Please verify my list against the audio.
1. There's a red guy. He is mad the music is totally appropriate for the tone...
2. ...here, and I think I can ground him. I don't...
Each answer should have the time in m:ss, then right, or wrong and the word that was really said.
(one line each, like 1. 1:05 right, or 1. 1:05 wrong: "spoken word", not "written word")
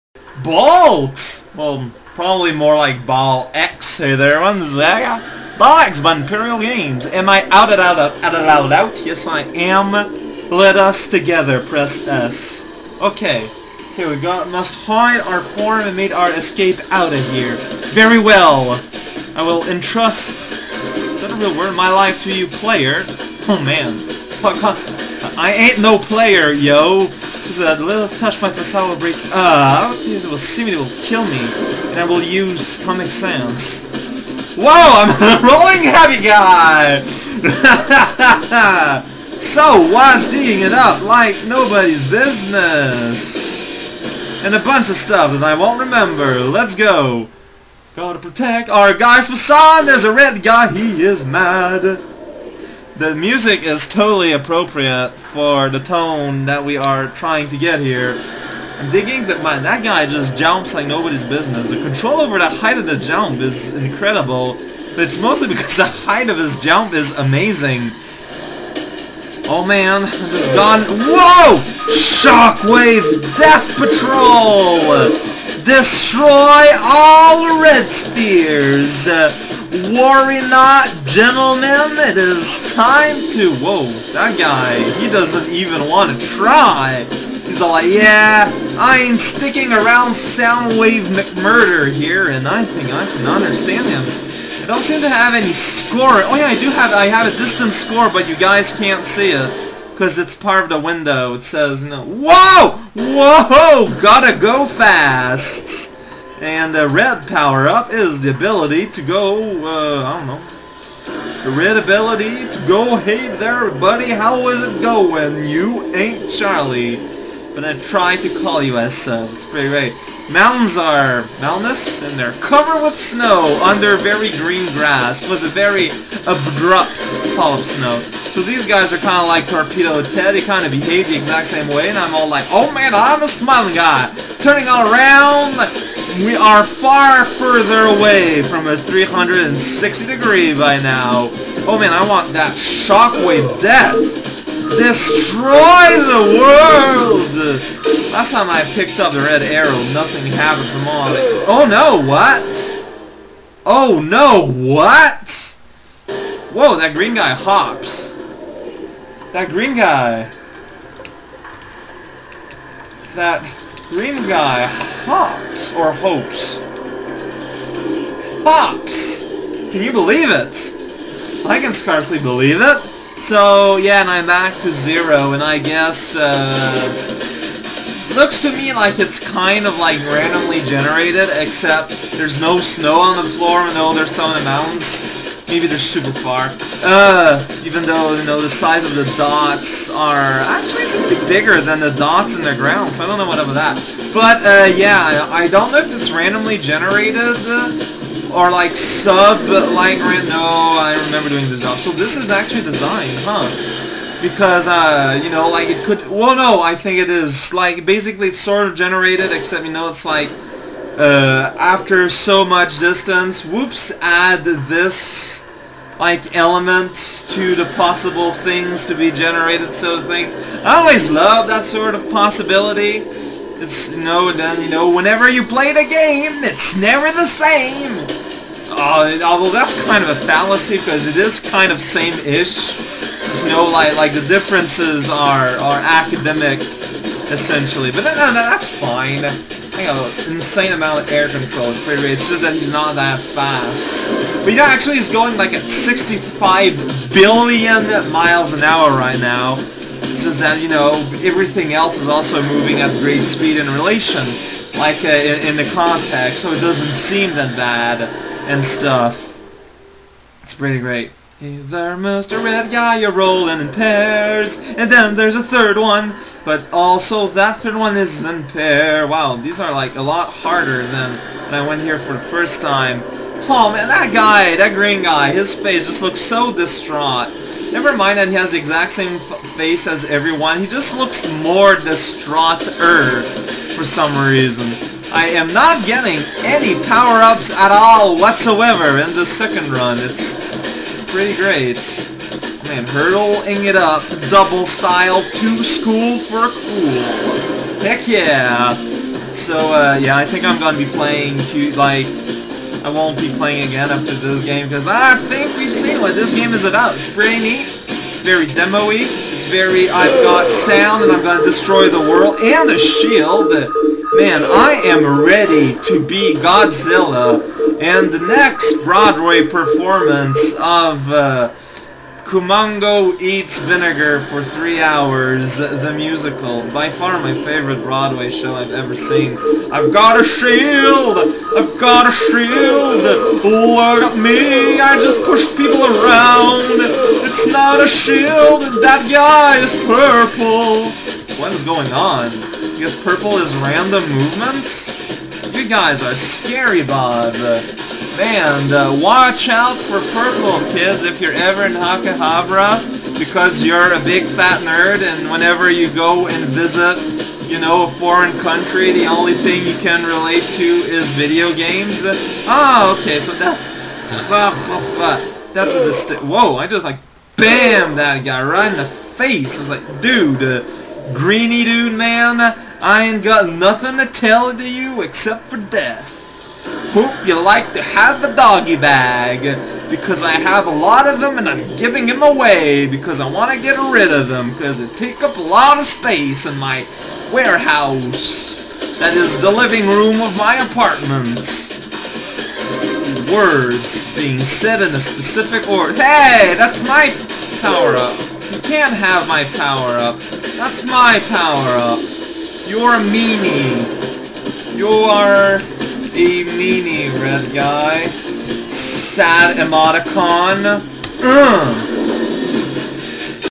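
1. 0:49 right
2. 1:31 wrong: "understand", not "ground".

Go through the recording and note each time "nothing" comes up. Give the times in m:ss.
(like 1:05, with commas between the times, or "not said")
2:29, 6:13.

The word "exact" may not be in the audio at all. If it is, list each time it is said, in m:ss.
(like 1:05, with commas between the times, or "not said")
2:11, 4:38.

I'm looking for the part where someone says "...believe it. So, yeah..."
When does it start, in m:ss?
2:52.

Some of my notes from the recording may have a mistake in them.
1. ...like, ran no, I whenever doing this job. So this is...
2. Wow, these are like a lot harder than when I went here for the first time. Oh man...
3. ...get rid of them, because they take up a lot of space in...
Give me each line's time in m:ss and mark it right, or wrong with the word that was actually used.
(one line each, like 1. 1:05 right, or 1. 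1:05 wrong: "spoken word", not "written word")
1. 3:19 wrong: "remember", not "whenever"
2. 4:29 right
3. 6:23 right.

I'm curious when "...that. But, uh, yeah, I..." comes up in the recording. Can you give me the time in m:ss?
3:13.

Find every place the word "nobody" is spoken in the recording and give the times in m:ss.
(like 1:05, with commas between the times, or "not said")
0:41, 1:00.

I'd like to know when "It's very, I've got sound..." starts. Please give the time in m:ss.
5:09.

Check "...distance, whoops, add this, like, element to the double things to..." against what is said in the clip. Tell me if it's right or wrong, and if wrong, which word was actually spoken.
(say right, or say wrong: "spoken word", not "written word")
wrong: "possible", not "double".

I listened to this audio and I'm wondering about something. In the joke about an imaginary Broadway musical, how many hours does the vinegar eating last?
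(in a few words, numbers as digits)
3.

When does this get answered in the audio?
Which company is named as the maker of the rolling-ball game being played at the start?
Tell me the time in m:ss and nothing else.
0:06.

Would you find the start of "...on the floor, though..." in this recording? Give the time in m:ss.
3:02.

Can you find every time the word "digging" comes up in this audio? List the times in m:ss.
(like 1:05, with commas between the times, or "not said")
0:40, 0:58.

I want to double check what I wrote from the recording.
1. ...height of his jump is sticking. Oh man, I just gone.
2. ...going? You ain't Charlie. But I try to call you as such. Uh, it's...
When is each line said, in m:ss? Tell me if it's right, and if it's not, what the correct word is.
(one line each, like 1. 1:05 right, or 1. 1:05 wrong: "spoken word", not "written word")
1. 1:05 wrong: "amazing", not "sticking"
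2. 1:54 right.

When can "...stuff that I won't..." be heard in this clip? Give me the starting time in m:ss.
0:44.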